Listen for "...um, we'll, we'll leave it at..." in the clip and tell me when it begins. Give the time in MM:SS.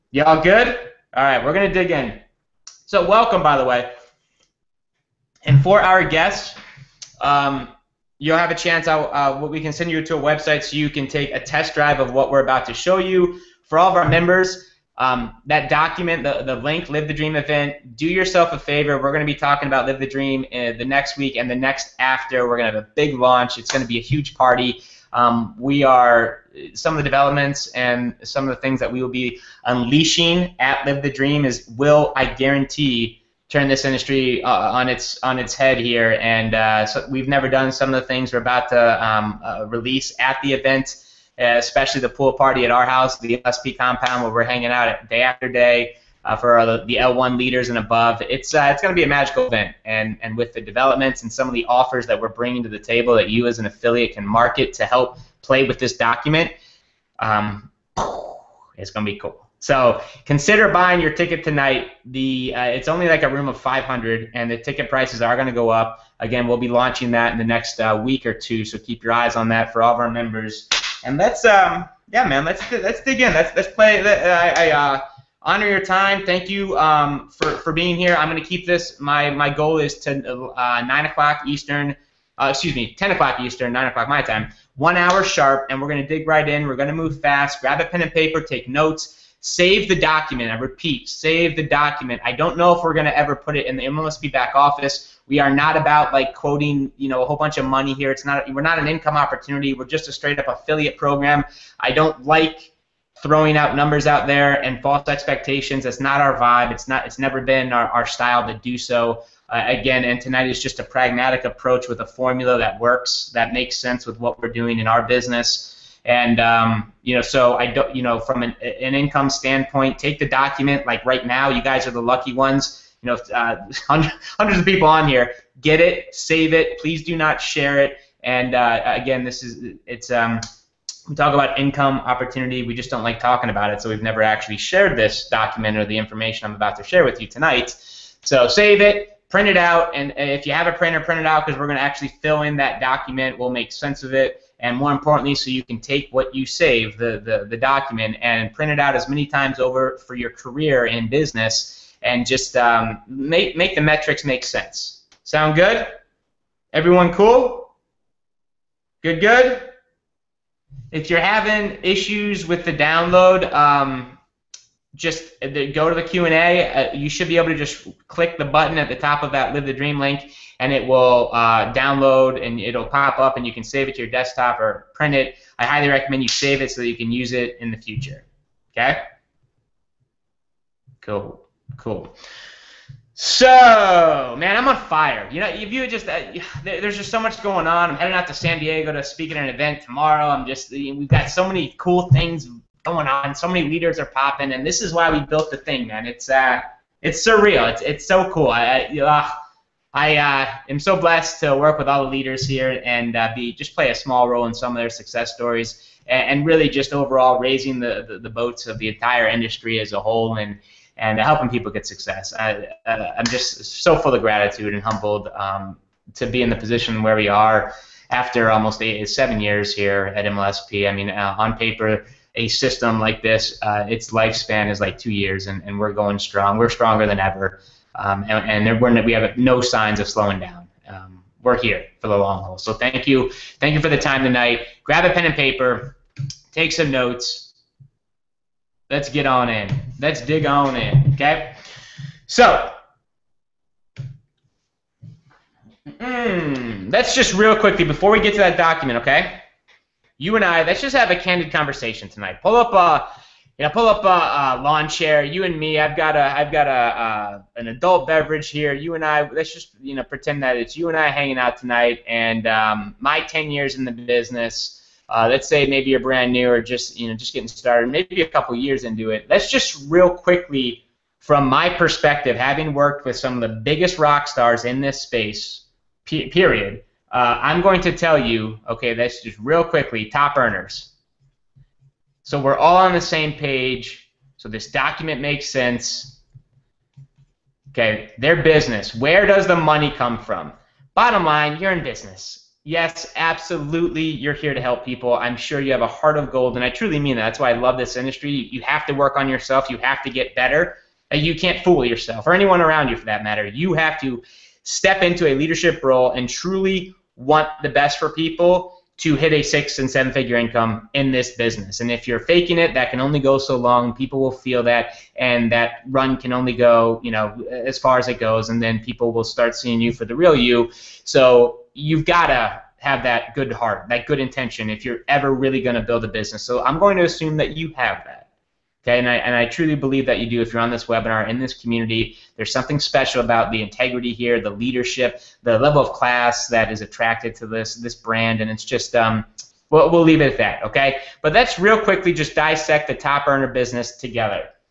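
05:38.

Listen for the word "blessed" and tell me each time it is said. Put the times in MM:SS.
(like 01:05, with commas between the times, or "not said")
03:20.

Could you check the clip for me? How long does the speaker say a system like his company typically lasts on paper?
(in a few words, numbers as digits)
2 years.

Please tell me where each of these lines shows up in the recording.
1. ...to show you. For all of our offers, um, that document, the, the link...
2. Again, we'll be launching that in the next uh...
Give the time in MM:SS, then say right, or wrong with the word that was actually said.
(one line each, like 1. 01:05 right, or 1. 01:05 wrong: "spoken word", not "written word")
1. 00:12 wrong: "members", not "offers"
2. 01:06 right.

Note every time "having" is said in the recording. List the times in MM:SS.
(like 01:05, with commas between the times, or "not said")
02:41, 04:32.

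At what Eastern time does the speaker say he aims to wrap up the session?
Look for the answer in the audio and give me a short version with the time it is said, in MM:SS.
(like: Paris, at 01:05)
10 o'clock Eastern, at 01:22.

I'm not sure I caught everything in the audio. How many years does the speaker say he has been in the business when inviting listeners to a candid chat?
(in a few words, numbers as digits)
10 years.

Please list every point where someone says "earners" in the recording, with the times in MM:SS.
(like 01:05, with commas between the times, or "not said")
04:40, 05:43.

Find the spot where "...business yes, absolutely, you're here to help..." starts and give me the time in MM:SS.
04:51.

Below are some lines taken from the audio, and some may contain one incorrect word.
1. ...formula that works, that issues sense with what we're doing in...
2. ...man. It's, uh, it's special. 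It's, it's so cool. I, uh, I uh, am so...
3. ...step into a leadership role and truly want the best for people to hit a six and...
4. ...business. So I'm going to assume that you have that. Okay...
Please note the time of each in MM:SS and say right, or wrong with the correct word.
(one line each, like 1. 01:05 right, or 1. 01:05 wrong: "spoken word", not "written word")
1. 01:52 wrong: "makes", not "issues"
2. 03:15 wrong: "surreal", not "special"
3. 05:04 right
4. 05:26 right.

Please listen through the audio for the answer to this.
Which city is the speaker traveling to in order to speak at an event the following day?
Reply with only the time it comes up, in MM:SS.
03:08.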